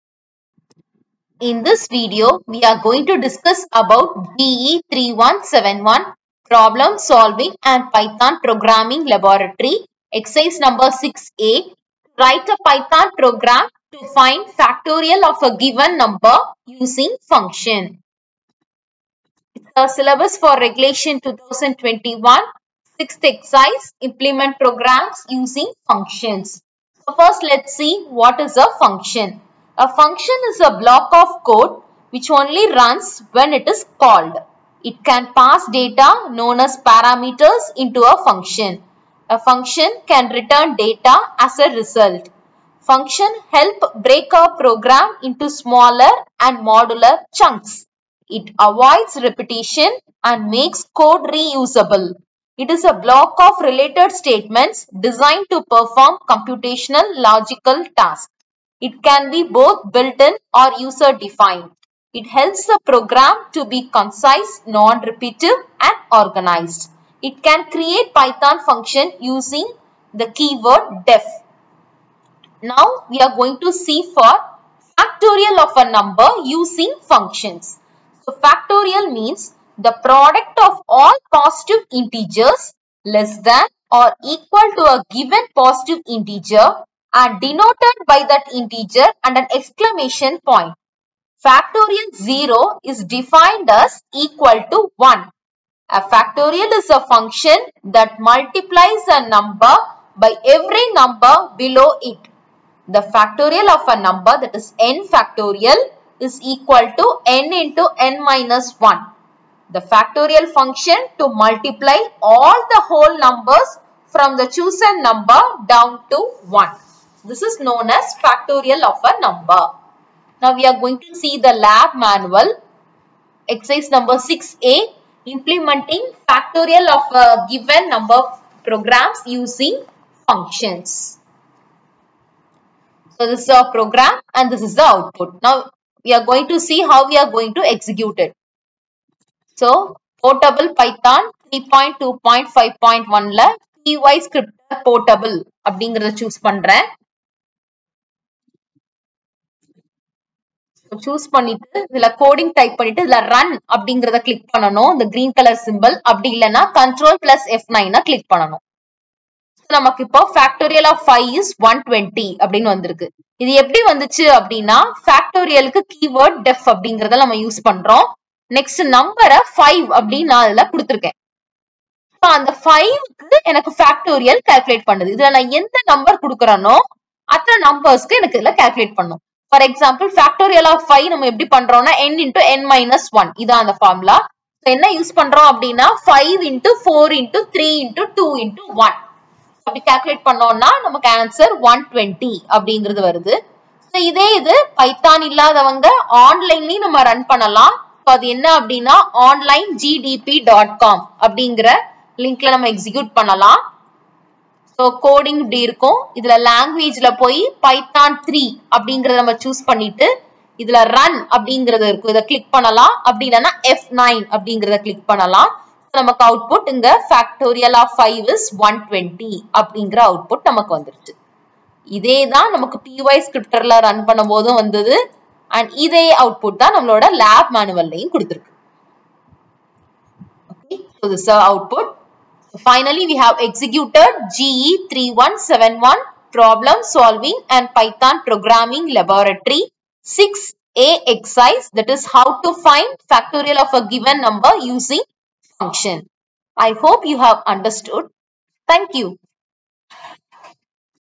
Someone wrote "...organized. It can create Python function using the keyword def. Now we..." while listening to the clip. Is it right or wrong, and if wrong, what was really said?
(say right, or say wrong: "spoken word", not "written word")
right.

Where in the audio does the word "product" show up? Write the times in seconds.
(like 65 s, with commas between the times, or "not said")
80 s.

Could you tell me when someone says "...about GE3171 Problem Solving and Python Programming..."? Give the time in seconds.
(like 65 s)
3 s.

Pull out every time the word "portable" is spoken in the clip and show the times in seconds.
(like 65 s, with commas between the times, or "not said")
140 s, 144 s.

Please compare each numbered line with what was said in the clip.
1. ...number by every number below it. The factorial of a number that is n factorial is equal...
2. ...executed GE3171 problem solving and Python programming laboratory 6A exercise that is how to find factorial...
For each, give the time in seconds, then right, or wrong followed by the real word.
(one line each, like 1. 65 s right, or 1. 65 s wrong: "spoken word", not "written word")
1. 99 s right
2. 233 s right.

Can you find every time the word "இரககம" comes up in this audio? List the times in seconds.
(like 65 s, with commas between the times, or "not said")
205 s, 211 s.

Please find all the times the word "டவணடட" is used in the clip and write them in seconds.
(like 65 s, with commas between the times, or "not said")
161 s, 191 s, 218 s.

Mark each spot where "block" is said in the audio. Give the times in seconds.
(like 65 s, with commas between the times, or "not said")
30 s, 52 s.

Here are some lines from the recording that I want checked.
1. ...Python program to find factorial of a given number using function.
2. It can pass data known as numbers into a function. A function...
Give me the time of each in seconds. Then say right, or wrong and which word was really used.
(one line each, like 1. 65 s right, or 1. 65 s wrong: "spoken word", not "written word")
1. 12 s right
2. 34 s wrong: "parameters", not "numbers".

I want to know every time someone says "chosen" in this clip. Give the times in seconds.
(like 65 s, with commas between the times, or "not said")
114 s.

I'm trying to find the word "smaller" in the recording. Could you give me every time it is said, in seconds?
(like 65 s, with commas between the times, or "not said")
45 s.